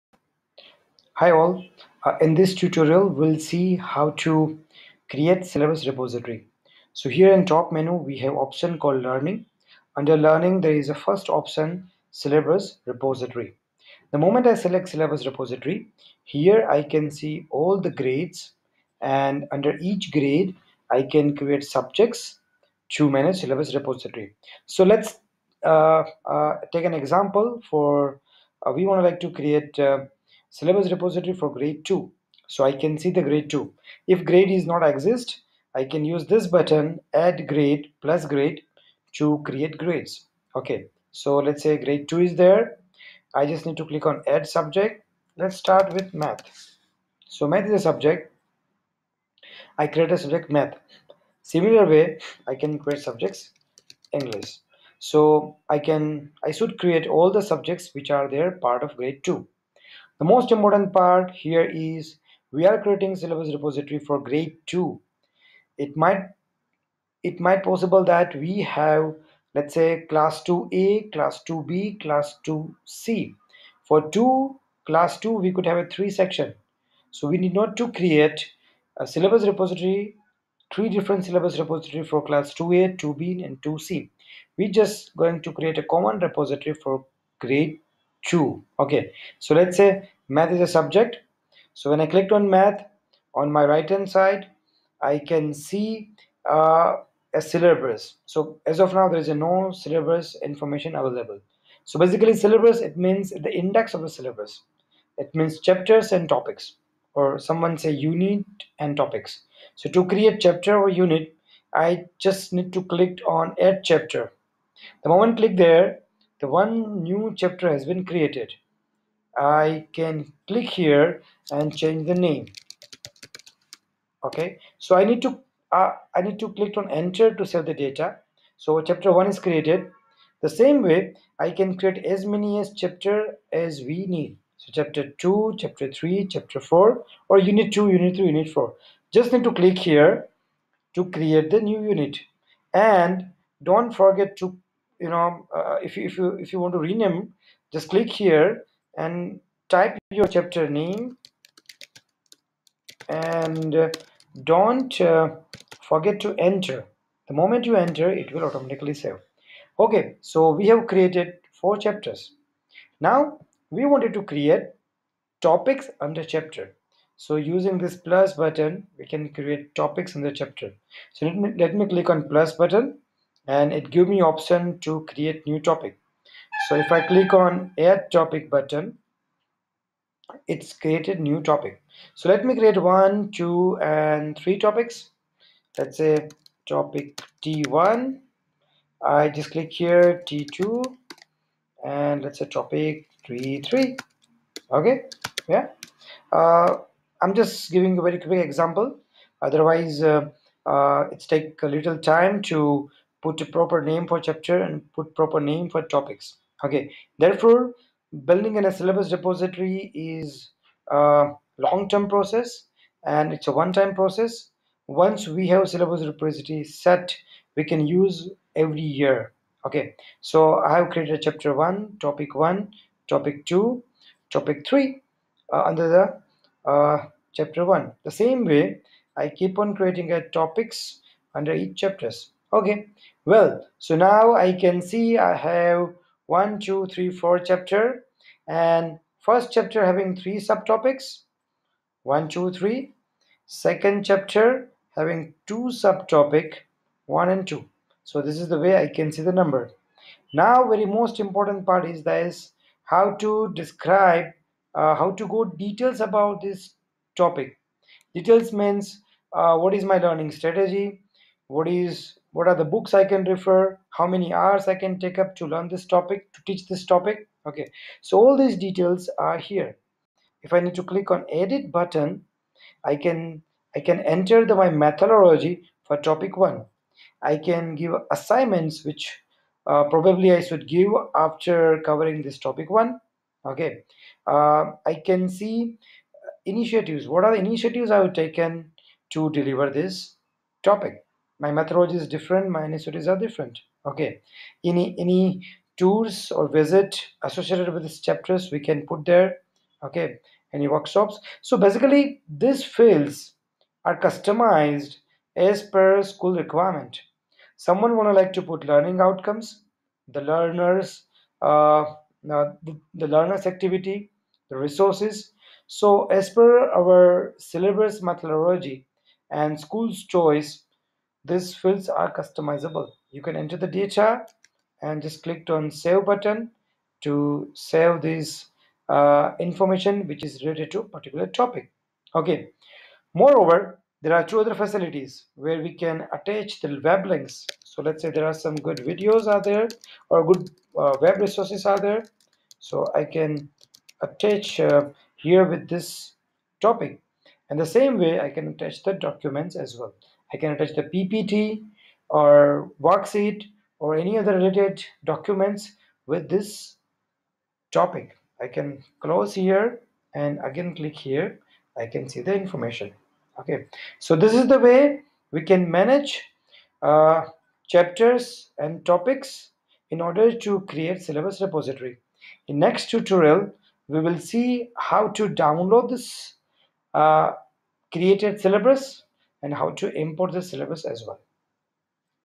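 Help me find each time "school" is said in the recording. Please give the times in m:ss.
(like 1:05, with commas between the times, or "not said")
5:06, 5:19.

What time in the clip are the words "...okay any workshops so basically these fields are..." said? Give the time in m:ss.
4:59.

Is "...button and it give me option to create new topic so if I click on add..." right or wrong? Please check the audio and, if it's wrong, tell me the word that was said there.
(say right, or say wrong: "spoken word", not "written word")
right.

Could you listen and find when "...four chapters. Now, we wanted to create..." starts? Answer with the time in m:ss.
2:41.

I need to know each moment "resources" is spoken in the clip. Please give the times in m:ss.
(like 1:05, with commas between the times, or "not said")
5:14, 5:41.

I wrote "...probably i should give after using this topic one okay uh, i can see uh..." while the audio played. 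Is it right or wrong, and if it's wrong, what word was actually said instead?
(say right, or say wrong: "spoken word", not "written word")
wrong: "covering", not "using".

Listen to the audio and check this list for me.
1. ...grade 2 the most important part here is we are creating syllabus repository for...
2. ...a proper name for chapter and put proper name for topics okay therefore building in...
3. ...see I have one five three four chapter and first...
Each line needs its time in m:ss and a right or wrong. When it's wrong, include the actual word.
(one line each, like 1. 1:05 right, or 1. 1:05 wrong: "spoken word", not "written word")
1. 0:58 right
2. 3:23 right
3. 3:54 wrong: "two", not "five".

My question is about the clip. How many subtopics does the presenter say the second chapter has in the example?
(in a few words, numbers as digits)
2.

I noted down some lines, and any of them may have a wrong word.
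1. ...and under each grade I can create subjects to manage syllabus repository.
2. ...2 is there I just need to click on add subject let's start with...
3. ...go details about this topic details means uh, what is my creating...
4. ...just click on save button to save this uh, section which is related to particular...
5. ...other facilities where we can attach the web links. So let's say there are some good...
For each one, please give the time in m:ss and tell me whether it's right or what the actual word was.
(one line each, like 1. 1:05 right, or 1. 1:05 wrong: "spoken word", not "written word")
1. 0:19 right
2. 0:42 right
3. 4:15 wrong: "learning", not "creating"
4. 5:25 wrong: "information", not "section"
5. 5:34 right.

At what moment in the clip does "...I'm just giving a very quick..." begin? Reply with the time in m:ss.
3:17.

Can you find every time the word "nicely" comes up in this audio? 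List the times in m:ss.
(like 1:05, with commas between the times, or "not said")
not said.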